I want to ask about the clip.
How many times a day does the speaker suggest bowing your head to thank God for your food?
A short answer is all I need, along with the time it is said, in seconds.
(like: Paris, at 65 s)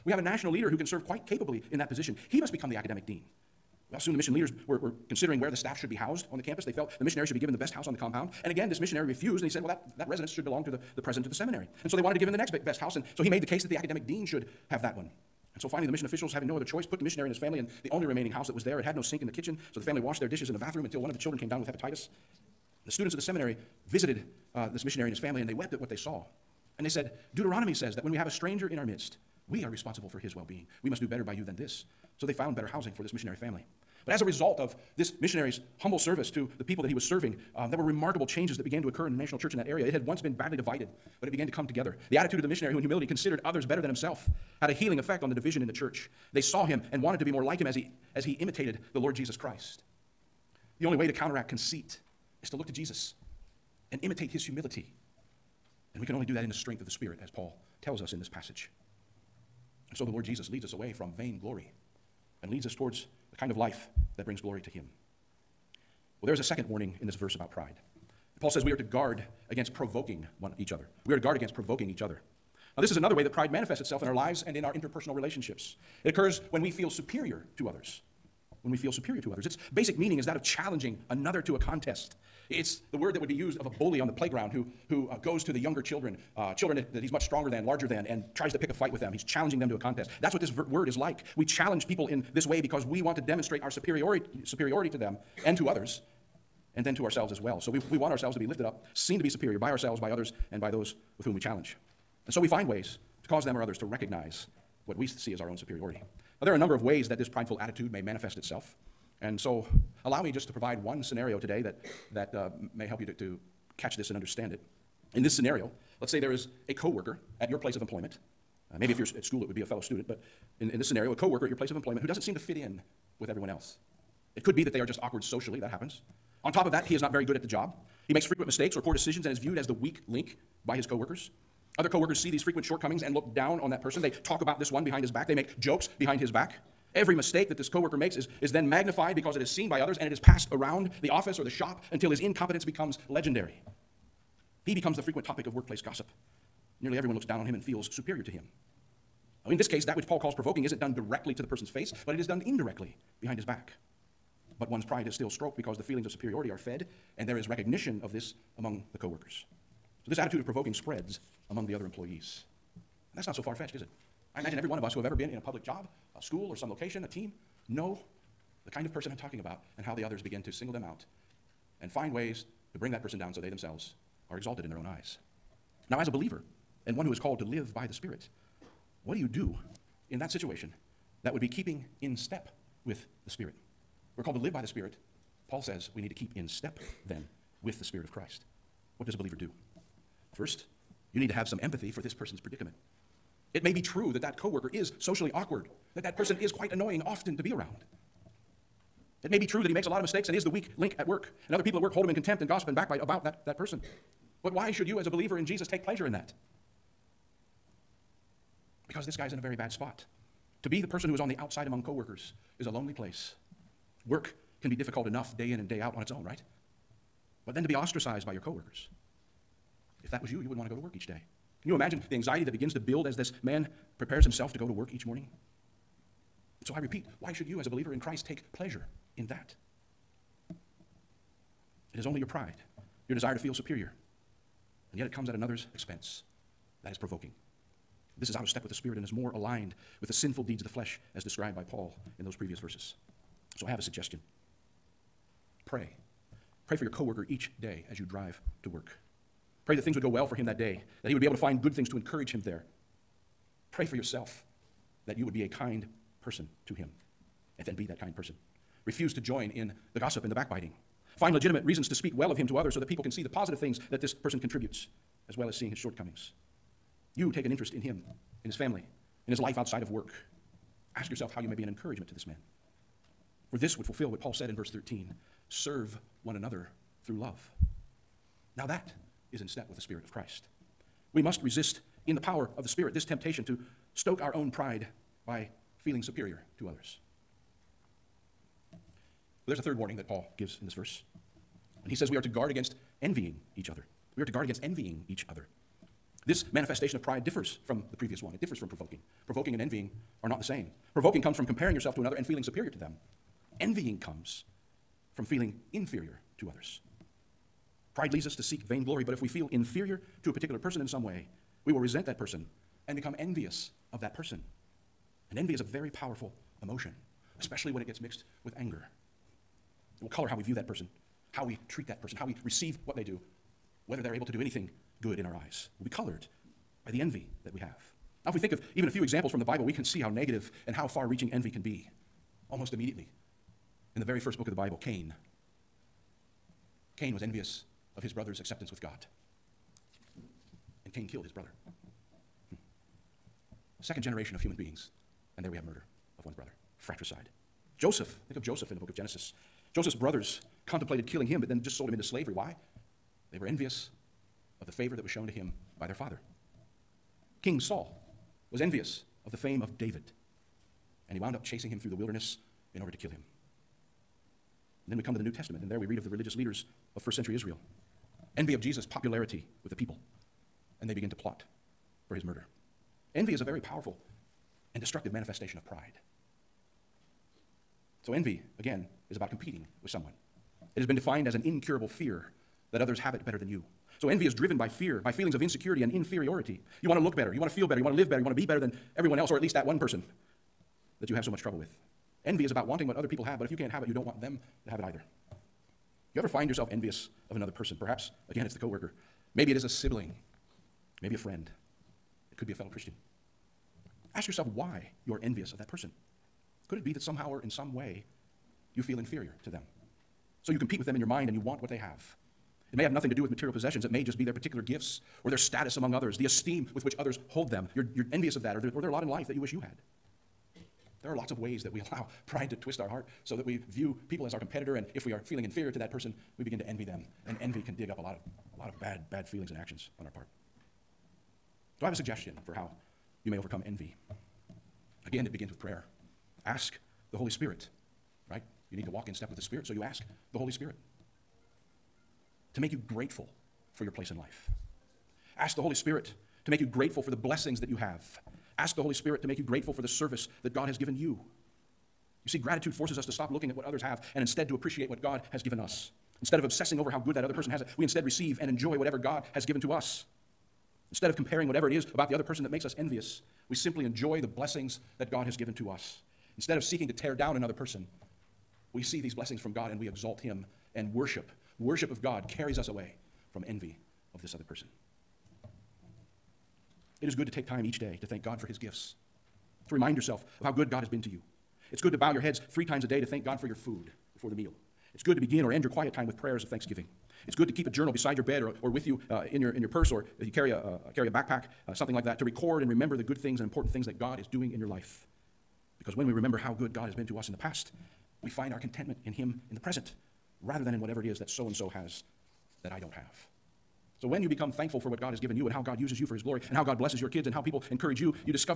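3, at 482 s.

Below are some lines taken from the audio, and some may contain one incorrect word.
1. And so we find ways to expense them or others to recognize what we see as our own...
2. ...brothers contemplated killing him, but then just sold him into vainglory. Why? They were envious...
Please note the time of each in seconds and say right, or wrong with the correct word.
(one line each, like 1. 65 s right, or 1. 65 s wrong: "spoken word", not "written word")
1. 102 s wrong: "cause", not "expense"
2. 349 s wrong: "slavery", not "vainglory".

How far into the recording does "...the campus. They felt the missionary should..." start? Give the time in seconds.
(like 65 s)
6 s.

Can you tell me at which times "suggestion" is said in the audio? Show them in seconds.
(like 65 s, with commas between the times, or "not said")
243 s, 431 s.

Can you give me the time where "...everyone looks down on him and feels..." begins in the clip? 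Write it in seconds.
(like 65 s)
146 s.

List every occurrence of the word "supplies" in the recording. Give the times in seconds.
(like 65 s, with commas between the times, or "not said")
not said.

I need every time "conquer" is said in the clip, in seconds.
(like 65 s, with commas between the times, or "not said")
not said.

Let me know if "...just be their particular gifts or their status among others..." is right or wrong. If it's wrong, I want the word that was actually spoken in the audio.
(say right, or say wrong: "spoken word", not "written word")
right.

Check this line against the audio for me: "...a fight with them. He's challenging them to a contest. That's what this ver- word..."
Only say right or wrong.
right.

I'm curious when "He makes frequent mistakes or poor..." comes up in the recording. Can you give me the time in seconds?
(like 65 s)
128 s.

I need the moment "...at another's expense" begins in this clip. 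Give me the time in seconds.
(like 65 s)
235 s.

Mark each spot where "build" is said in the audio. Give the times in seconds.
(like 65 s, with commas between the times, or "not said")
222 s.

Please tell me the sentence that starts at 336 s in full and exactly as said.
Cain was envious of his brother's acceptance with God.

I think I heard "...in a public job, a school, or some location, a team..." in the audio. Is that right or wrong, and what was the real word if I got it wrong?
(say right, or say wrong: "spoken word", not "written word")
right.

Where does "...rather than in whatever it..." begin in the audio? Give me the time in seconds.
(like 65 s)
500 s.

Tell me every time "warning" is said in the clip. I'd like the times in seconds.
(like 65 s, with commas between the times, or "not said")
66 s, 289 s.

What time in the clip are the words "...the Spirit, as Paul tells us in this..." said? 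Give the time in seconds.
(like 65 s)
56 s.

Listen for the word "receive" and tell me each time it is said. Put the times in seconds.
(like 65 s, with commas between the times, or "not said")
322 s, 458 s.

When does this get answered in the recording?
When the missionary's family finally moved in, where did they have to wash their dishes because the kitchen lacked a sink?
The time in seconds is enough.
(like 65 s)
20 s.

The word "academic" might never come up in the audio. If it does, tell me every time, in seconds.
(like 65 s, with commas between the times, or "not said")
2 s, 13 s.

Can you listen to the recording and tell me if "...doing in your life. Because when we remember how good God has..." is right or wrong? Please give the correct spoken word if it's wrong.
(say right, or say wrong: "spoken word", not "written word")
right.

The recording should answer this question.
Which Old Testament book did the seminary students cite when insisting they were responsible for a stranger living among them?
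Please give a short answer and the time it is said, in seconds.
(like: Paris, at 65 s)
Deuteronomy, at 27 s.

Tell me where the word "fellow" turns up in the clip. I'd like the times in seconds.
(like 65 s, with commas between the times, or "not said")
119 s, 402 s.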